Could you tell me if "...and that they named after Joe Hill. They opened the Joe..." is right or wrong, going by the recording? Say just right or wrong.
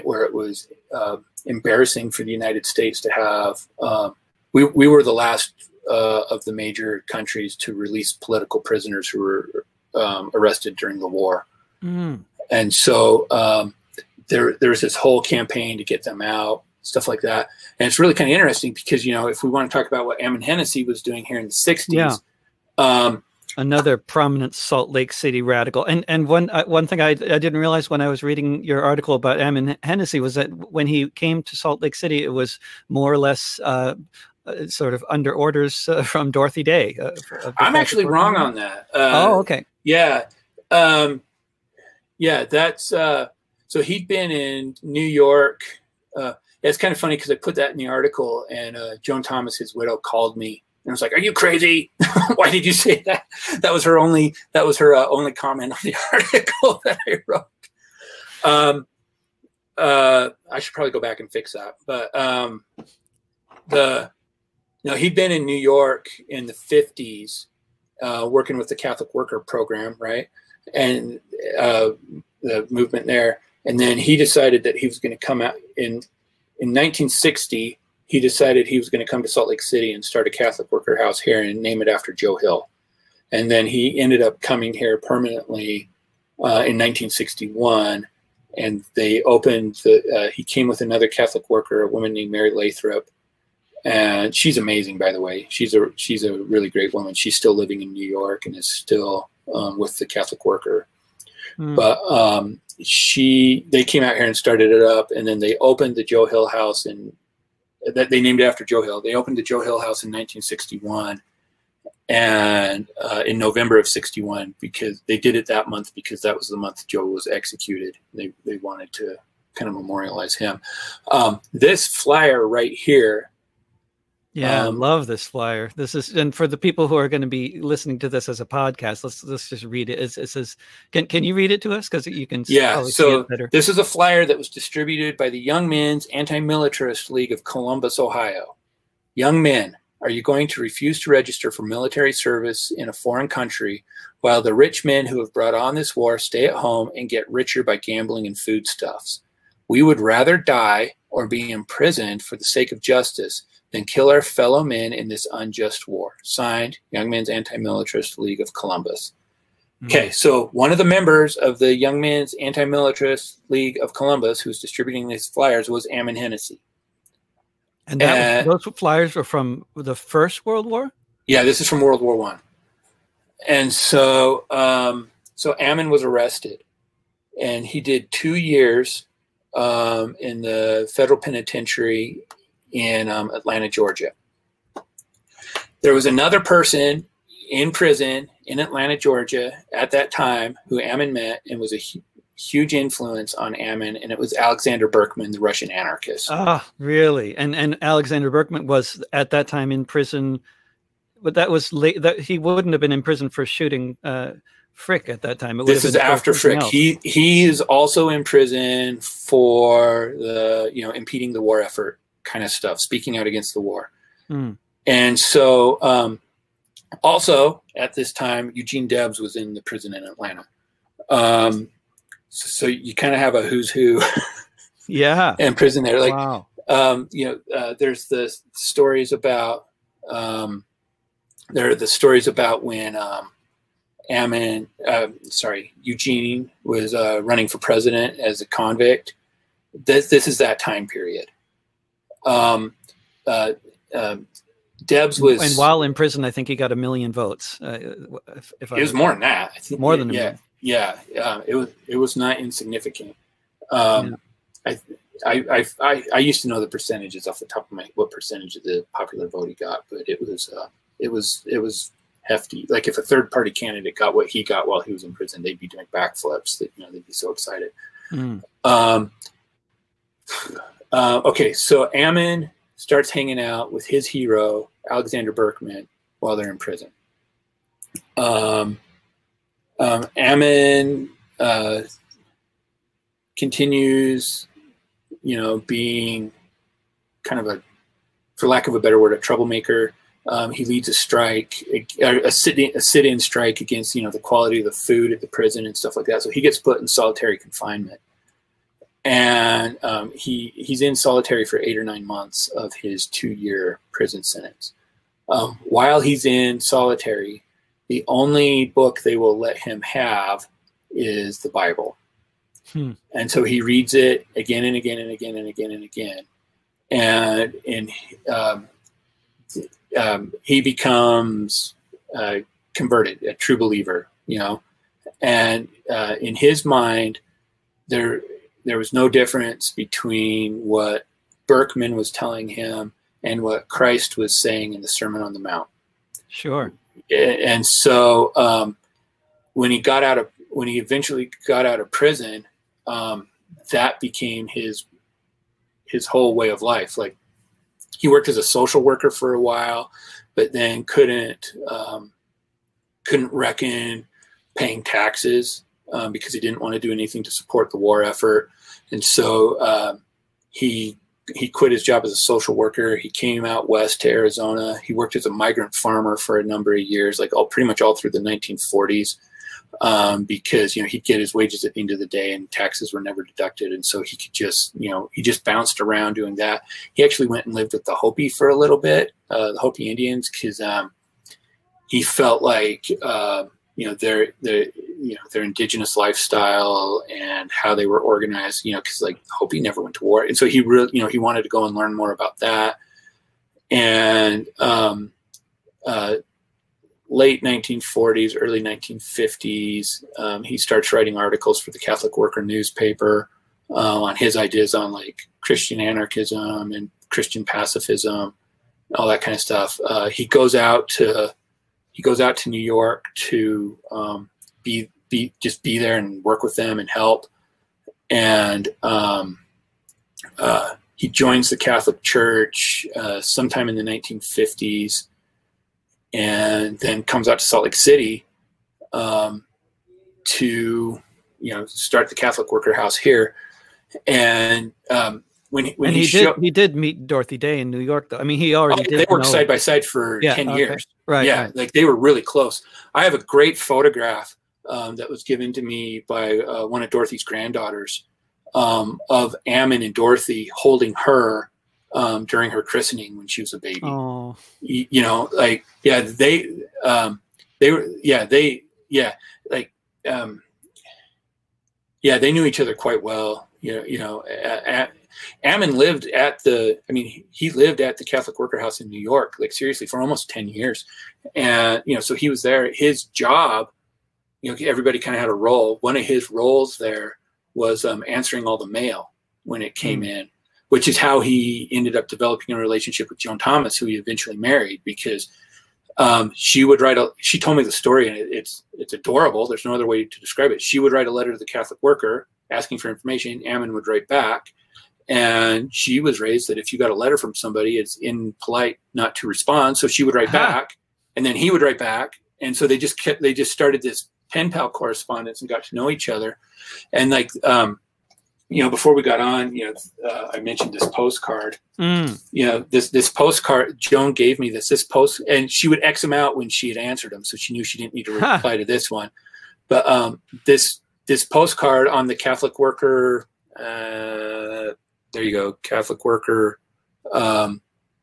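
right.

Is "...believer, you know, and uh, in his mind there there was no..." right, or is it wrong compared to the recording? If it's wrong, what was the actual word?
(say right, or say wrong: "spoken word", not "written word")
right.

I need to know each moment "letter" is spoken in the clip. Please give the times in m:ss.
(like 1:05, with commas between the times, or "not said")
8:11, 8:16.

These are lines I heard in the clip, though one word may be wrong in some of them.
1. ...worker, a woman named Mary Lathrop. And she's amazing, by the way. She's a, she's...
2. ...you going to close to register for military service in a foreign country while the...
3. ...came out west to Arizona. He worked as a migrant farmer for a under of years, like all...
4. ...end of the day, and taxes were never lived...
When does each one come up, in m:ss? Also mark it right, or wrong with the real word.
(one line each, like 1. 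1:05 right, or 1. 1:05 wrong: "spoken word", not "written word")
1. 1:31 right
2. 2:20 wrong: "refuse", not "close"
3. 6:03 wrong: "number", not "under"
4. 6:11 wrong: "deducted", not "lived".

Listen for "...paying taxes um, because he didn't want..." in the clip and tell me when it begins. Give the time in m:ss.
5:54.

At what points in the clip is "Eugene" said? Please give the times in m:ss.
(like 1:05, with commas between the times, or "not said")
3:38, 3:55.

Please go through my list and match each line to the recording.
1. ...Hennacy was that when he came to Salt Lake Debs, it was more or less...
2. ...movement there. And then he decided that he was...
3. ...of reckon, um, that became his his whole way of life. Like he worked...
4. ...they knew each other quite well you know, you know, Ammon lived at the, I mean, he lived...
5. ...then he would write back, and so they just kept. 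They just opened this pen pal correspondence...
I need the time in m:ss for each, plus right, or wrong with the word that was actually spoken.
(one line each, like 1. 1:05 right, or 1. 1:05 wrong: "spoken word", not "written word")
1. 0:29 wrong: "City", not "Debs"
2. 1:12 right
3. 5:41 wrong: "prison", not "reckon"
4. 7:42 right
5. 8:21 wrong: "started", not "opened".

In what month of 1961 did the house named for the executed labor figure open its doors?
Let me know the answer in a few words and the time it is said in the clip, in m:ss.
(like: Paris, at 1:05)
November, at 1:53.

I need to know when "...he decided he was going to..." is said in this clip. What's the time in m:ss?
1:18.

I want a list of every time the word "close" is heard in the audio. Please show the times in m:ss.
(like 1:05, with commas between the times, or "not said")
7:22.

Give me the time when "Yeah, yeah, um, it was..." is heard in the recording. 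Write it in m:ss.
4:10.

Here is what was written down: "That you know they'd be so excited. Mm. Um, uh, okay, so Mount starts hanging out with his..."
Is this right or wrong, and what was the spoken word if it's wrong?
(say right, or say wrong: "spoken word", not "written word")
wrong: "Ammon", not "Mount".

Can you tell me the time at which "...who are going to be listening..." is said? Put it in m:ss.
2:06.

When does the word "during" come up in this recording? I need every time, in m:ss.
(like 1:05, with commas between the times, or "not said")
0:10, 7:32.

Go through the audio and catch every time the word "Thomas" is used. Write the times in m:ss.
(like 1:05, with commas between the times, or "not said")
0:49, 8:03.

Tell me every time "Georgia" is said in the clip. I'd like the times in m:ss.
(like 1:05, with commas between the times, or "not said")
3:03, 3:08.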